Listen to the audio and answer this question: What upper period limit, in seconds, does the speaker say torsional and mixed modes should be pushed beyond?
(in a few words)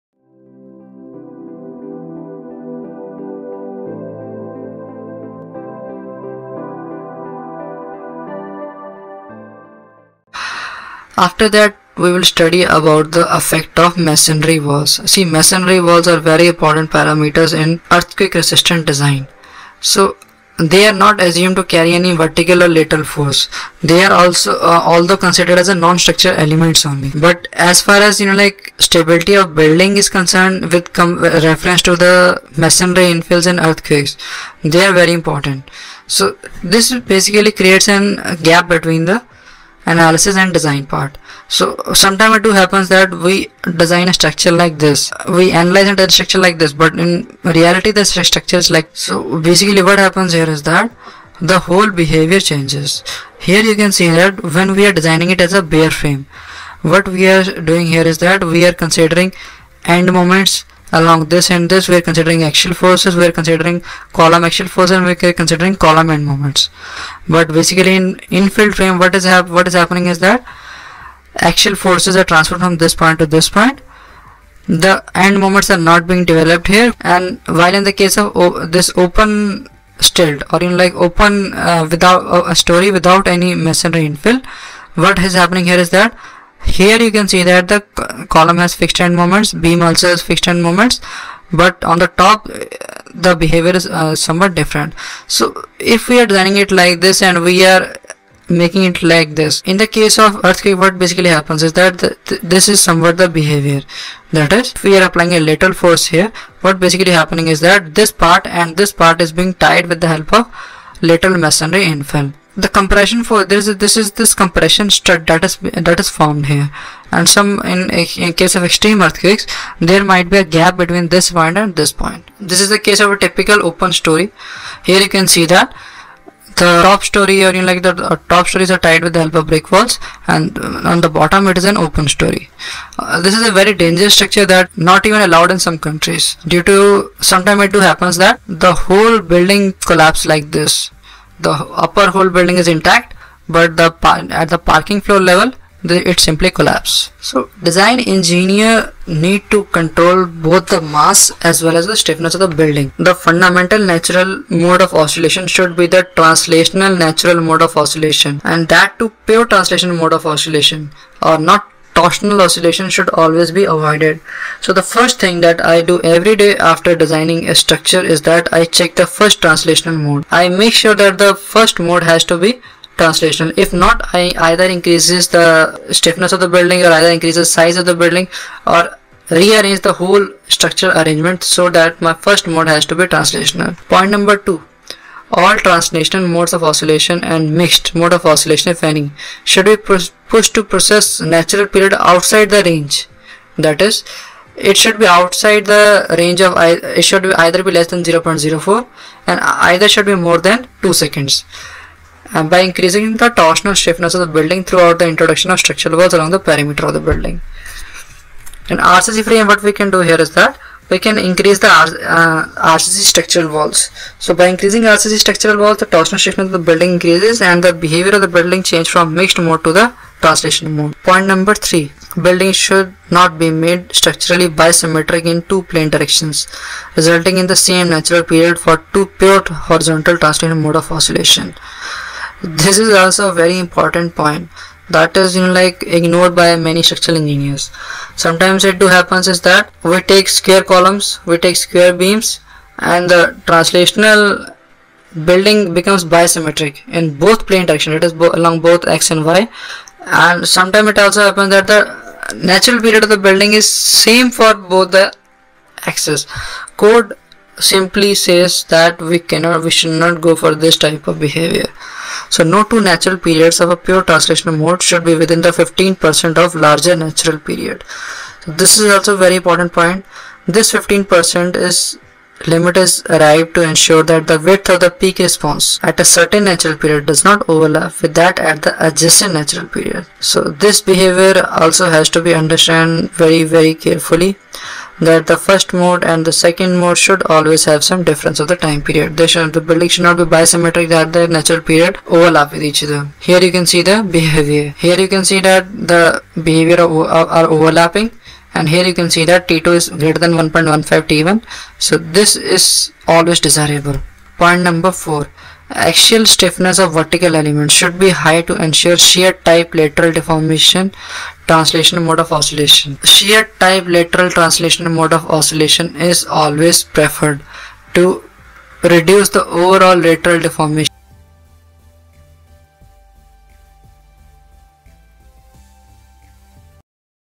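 2 seconds.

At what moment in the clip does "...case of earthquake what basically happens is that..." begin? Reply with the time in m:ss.
1:39.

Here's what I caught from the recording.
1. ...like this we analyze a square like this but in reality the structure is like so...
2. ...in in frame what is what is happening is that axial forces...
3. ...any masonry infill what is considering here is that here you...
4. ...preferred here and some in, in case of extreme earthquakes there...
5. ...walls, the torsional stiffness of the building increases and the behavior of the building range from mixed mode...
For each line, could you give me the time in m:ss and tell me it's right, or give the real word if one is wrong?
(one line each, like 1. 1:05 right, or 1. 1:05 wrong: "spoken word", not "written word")
1. 0:44 wrong: "structure", not "square"
2. 1:07 right
3. 1:23 wrong: "happening", not "considering"
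4. 1:56 wrong: "formed", not "preferred"
5. 3:35 wrong: "change", not "range".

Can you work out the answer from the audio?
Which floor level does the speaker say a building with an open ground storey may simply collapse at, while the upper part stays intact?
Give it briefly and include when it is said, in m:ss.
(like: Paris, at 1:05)
parking floor level, at 2:24.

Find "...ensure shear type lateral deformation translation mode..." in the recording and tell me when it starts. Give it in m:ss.
5:08.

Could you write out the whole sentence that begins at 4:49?
They should, the building should not be bisymmetric that the natural period overlap with each other.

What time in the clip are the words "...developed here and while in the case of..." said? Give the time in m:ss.
1:16.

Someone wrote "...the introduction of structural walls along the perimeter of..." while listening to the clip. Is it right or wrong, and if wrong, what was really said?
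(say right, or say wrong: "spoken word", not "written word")
right.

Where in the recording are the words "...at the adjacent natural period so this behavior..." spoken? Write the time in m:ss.
4:38.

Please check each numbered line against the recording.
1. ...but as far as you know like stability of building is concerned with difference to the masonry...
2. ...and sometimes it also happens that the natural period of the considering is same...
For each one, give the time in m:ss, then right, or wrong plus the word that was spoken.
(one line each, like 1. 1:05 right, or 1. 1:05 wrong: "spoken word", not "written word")
1. 0:27 wrong: "reference", not "difference"
2. 4:10 wrong: "building", not "considering".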